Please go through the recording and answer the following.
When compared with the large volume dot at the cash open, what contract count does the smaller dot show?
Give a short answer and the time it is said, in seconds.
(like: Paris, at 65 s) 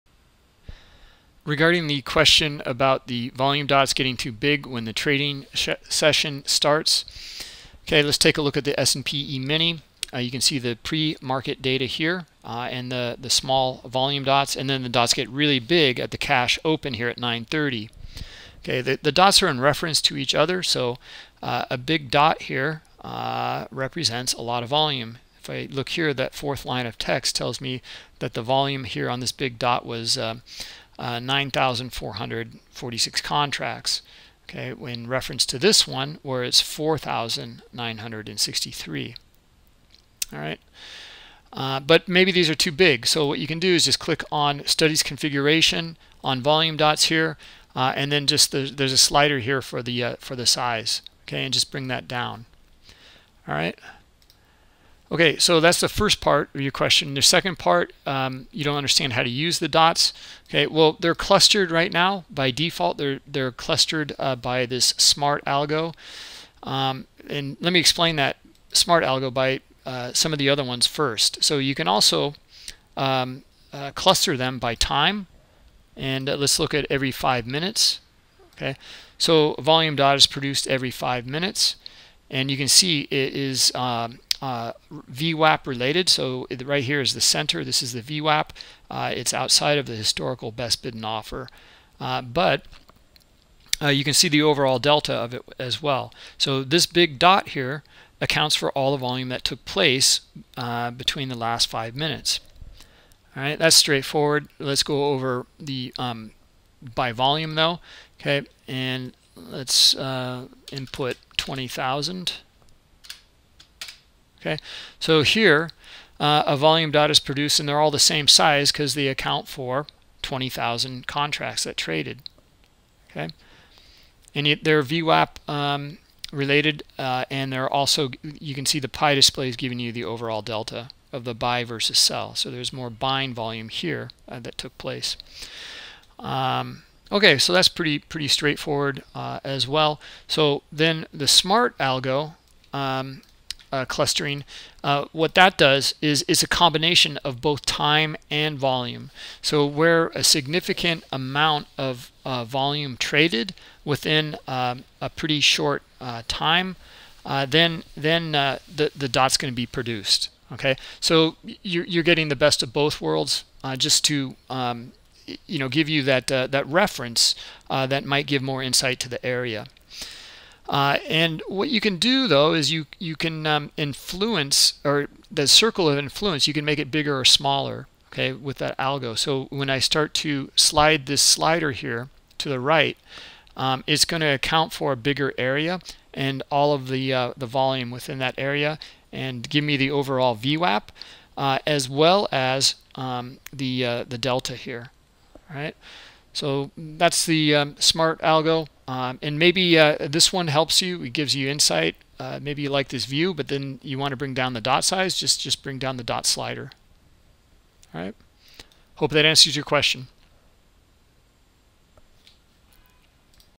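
4,963, at 36 s.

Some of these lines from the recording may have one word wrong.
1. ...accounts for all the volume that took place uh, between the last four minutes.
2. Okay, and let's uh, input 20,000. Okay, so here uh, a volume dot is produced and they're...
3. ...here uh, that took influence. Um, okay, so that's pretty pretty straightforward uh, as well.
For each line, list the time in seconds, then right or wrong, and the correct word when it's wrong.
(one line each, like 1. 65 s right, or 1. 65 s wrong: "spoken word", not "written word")
1. 98 s wrong: "five", not "four"
2. 108 s right
3. 133 s wrong: "place", not "influence".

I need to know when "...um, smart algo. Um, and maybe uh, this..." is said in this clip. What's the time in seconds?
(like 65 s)
197 s.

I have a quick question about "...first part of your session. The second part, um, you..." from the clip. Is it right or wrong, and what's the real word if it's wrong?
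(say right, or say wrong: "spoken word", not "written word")
wrong: "question", not "session".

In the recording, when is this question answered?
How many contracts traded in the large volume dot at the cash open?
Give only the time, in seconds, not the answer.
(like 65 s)
31 s.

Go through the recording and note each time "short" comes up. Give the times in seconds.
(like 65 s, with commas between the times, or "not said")
155 s.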